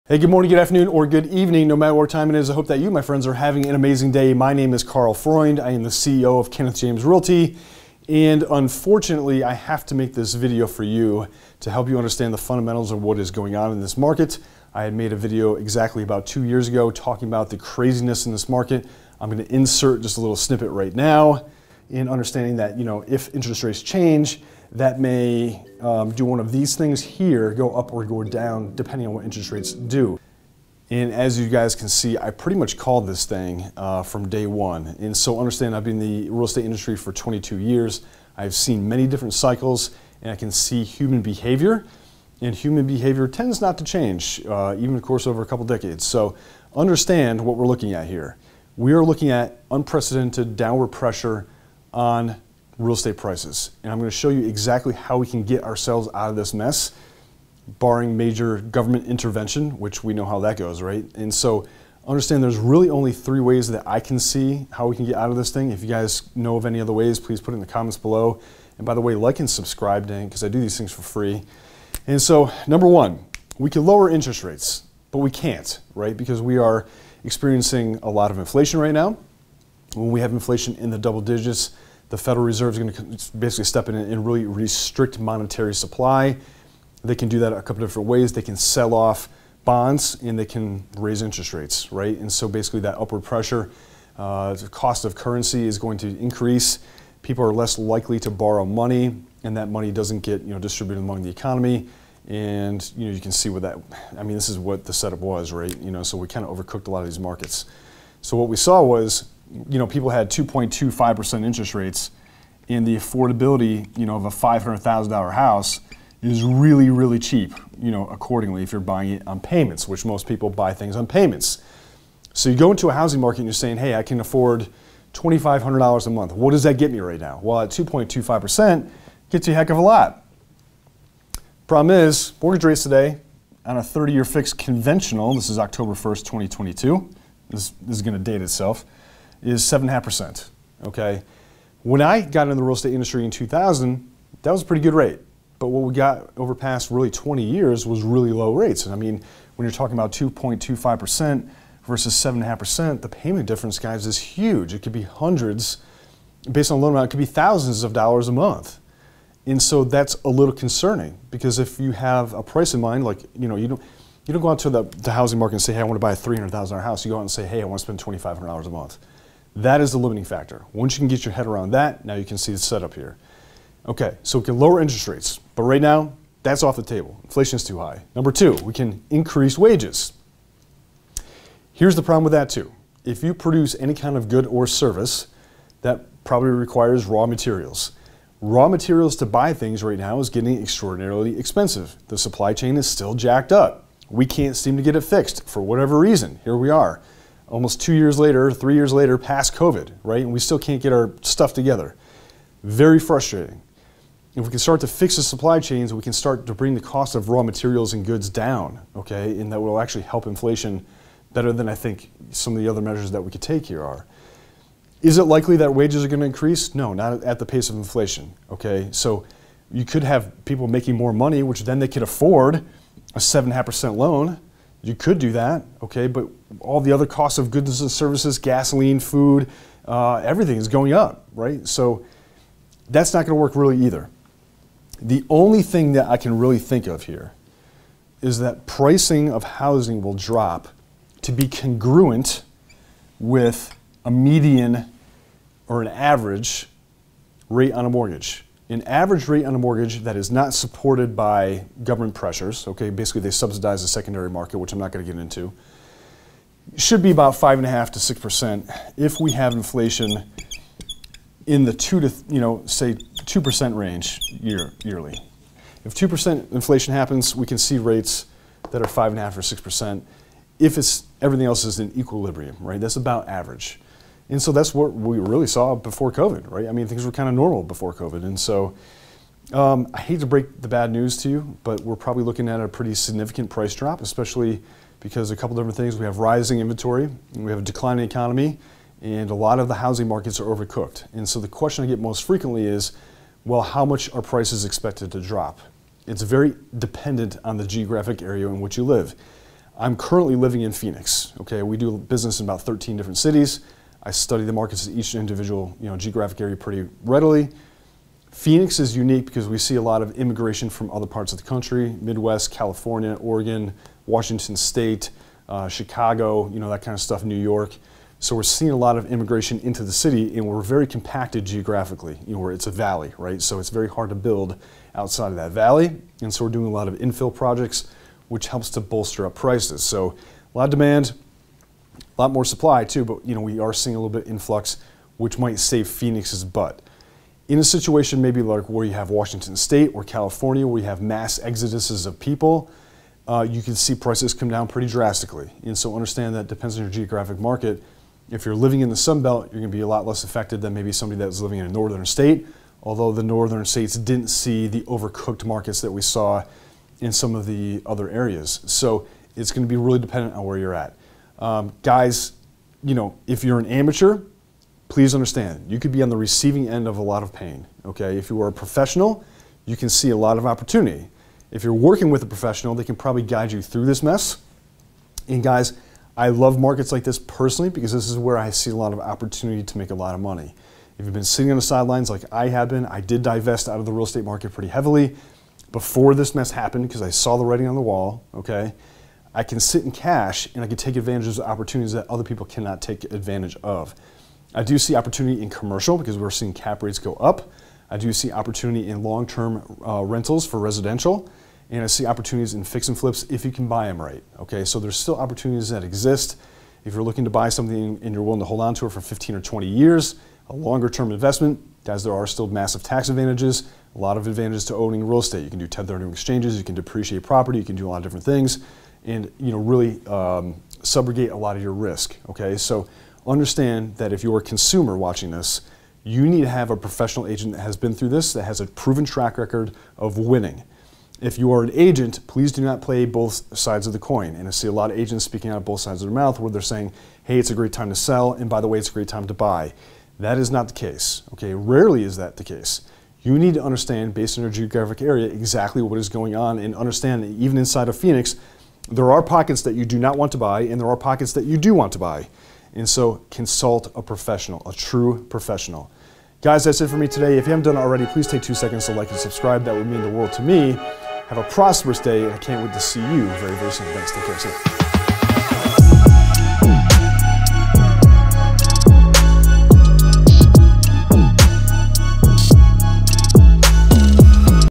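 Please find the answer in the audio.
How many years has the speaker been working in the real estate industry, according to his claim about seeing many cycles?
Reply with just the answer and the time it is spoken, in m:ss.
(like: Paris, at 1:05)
22, at 0:37.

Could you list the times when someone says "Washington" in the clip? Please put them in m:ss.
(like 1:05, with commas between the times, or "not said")
5:14, 5:39.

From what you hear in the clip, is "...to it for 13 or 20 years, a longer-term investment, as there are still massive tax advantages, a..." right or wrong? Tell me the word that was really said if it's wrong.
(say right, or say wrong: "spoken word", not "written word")
wrong: "15", not "13".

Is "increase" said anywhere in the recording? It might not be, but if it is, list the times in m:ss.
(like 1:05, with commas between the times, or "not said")
1:36, 2:59, 3:36.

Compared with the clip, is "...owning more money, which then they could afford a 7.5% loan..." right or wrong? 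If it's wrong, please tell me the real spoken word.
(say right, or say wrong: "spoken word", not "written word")
wrong: "making", not "owning".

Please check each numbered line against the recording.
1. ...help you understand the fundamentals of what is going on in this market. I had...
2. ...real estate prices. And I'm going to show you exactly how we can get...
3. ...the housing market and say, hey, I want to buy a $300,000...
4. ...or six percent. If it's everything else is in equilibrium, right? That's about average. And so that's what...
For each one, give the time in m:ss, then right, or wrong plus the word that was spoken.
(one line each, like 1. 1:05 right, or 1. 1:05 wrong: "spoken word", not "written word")
1. 0:11 right
2. 0:52 right
3. 2:44 right
4. 4:29 right.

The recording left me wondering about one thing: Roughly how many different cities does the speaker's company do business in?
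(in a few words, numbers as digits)
13.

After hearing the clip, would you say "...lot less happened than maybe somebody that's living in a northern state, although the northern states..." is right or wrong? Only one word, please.
wrong.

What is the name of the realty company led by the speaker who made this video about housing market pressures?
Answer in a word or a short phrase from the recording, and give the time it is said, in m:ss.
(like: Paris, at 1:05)
Kenneth James Realty, at 0:06.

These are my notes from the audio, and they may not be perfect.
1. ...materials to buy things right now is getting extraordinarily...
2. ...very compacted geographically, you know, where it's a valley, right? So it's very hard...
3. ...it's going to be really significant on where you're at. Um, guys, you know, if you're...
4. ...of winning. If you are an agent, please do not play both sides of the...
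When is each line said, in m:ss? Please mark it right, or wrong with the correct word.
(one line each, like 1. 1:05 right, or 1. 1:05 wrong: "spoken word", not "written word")
1. 3:08 right
2. 5:20 right
3. 5:59 wrong: "dependent", not "significant"
4. 7:09 right.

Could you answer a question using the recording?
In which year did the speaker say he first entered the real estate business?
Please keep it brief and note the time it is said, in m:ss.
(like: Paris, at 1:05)
2000, at 2:23.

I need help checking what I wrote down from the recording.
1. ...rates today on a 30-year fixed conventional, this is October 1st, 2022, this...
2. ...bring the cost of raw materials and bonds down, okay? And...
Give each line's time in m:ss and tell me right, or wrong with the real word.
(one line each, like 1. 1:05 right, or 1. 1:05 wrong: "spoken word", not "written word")
1. 2:12 right
2. 3:26 wrong: "goods", not "bonds".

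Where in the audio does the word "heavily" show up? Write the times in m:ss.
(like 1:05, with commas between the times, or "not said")
6:24.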